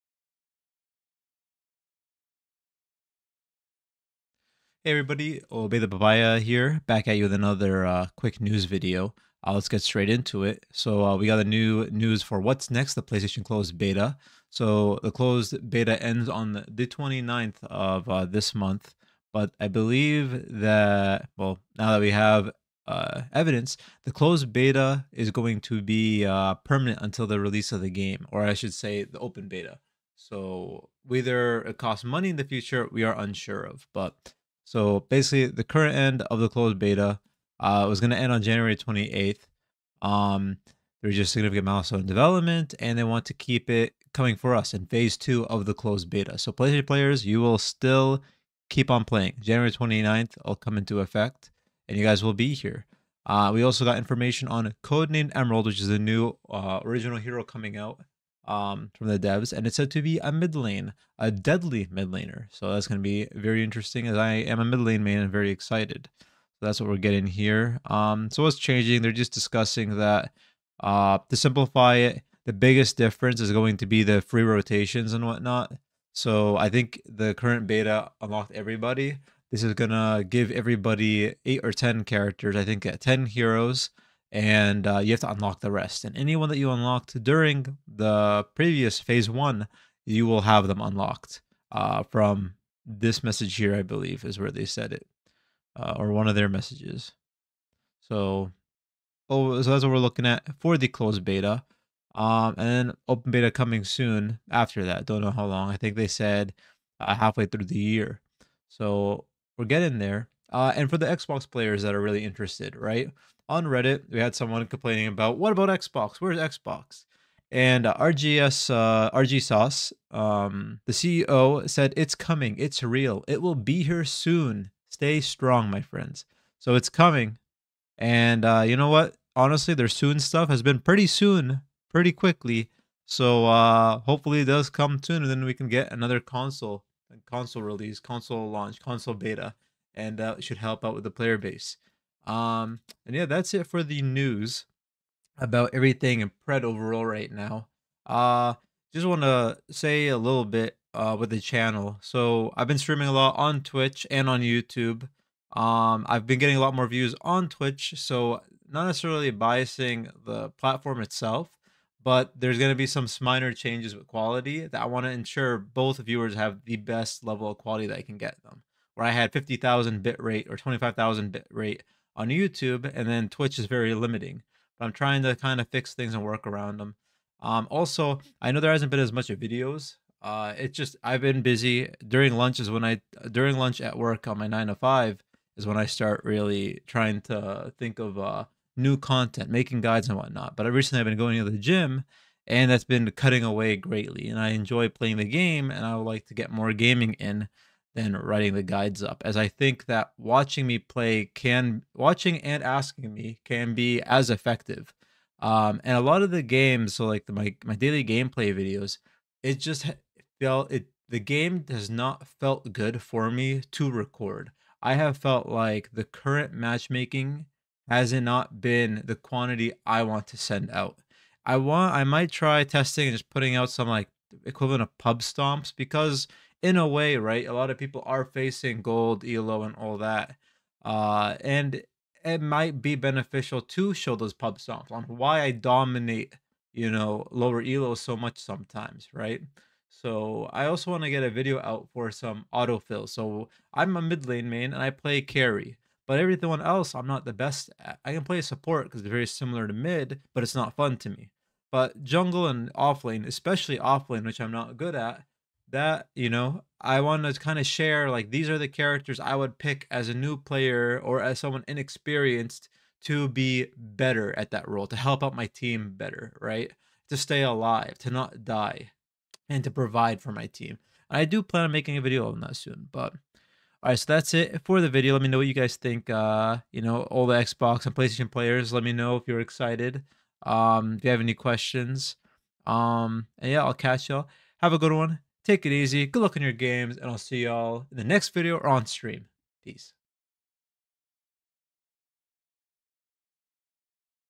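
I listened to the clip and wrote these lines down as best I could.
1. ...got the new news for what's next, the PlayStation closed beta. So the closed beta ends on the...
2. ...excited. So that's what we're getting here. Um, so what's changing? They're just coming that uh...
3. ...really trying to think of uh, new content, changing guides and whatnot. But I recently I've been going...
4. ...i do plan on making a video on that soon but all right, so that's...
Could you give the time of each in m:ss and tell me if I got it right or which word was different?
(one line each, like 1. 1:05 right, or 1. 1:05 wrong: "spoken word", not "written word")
1. 0:11 right
2. 1:05 wrong: "discussing", not "coming"
3. 3:06 wrong: "making", not "changing"
4. 4:31 right.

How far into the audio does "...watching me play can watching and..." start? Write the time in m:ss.
3:20.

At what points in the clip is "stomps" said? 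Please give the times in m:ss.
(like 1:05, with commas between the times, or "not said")
3:45, 3:54.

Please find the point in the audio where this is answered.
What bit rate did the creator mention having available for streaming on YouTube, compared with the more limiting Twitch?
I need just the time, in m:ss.
2:49.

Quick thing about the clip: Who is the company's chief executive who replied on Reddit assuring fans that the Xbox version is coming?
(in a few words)
RG Sauce.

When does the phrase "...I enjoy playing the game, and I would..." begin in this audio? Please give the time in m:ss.
3:14.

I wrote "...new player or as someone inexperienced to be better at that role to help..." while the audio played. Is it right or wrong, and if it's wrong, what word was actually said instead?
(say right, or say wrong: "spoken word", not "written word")
right.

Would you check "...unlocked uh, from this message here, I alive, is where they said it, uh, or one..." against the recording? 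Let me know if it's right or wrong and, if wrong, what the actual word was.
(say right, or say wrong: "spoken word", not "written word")
wrong: "believe", not "alive".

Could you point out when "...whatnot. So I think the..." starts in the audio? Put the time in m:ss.
1:15.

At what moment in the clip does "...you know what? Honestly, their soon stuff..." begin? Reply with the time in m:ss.
2:08.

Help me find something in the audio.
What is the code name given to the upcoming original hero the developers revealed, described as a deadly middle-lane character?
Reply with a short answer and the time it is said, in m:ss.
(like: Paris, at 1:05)
Codename Emerald, at 0:54.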